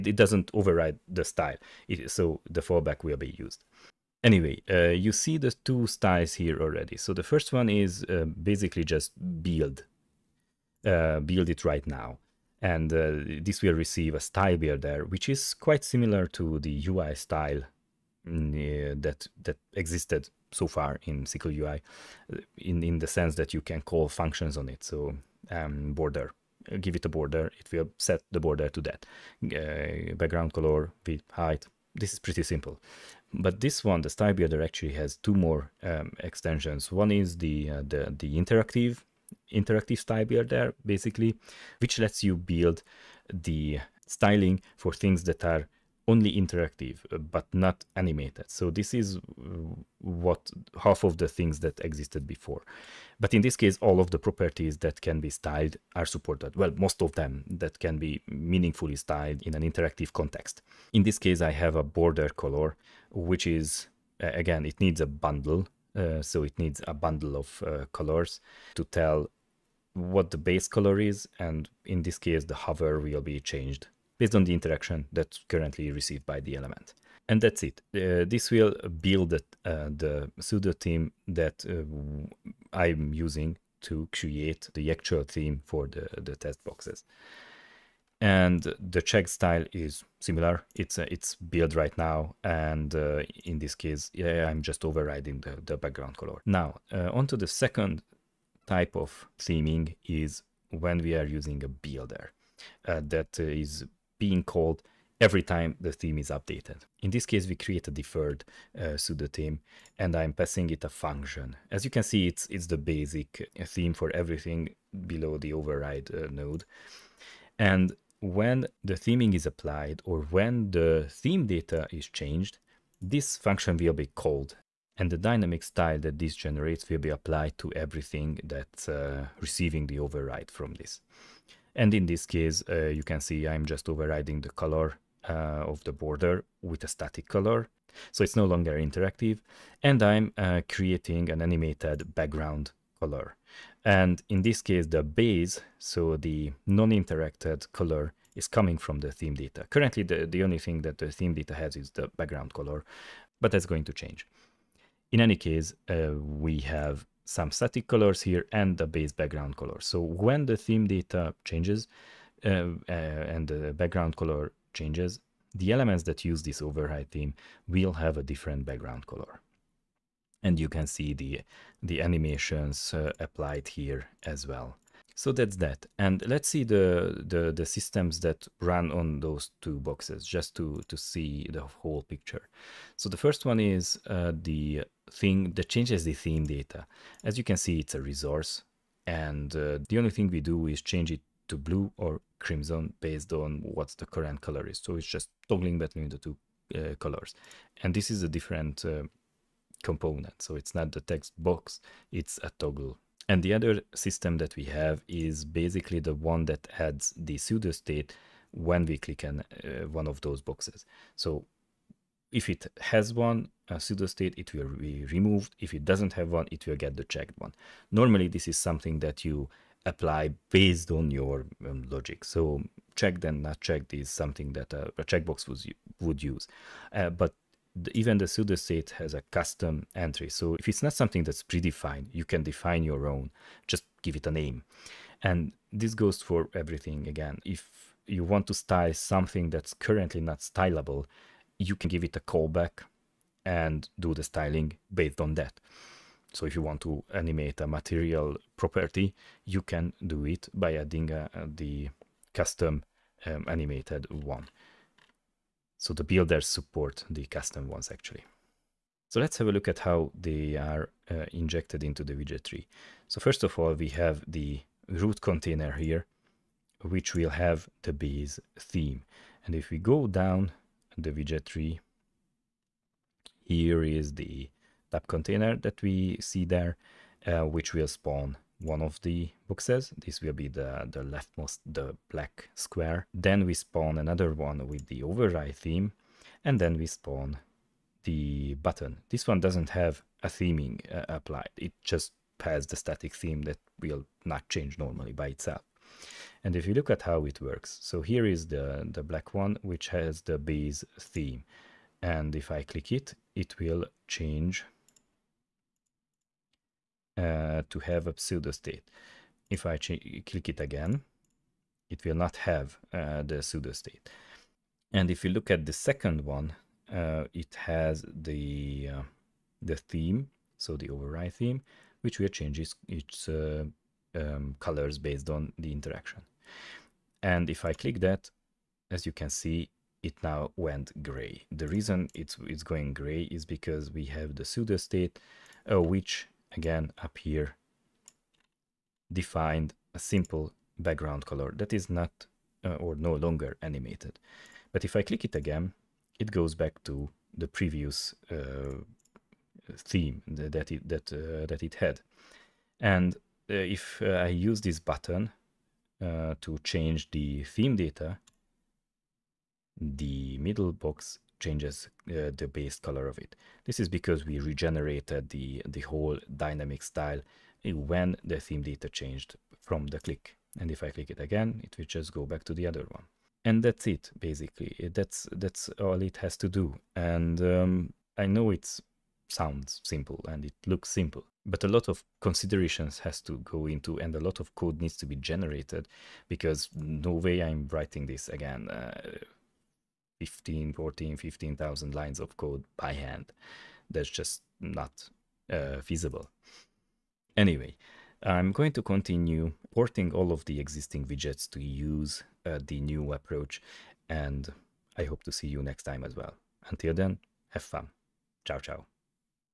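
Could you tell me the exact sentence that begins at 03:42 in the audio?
So checked and not checked is something that a, uh, a checkbox would, would use.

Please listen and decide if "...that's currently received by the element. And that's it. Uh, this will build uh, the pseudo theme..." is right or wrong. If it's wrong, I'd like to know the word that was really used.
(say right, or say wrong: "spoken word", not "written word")
right.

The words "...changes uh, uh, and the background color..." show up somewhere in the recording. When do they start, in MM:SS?
02:41.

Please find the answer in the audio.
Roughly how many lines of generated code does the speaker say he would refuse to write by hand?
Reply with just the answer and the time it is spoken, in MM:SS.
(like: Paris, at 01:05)
15,000, at 06:31.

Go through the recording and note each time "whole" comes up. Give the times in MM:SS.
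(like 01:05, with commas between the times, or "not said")
03:01, 06:05.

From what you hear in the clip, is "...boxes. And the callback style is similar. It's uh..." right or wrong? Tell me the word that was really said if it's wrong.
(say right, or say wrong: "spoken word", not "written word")
wrong: "check", not "callback".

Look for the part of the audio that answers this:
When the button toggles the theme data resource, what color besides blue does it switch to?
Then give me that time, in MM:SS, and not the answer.
03:12.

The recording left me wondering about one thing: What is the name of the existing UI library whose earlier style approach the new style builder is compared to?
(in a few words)
Sickle UI.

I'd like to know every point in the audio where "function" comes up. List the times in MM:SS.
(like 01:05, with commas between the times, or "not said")
00:24, 01:50, 02:03.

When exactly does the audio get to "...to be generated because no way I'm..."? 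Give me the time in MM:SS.
06:24.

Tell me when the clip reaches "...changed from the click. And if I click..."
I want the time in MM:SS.
06:08.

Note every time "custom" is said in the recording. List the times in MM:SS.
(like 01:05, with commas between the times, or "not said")
03:49, 04:12, 04:17.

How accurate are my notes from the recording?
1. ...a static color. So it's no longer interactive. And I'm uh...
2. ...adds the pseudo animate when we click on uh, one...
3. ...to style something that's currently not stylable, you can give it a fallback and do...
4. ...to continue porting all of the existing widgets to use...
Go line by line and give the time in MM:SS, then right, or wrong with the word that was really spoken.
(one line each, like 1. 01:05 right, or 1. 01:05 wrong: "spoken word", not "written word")
1. 02:16 right
2. 03:26 wrong: "state", not "animate"
3. 03:58 wrong: "callback", not "fallback"
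4. 06:38 right.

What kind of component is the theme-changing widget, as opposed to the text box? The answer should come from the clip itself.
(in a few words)
A toggle.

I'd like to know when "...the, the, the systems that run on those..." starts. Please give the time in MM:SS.
02:56.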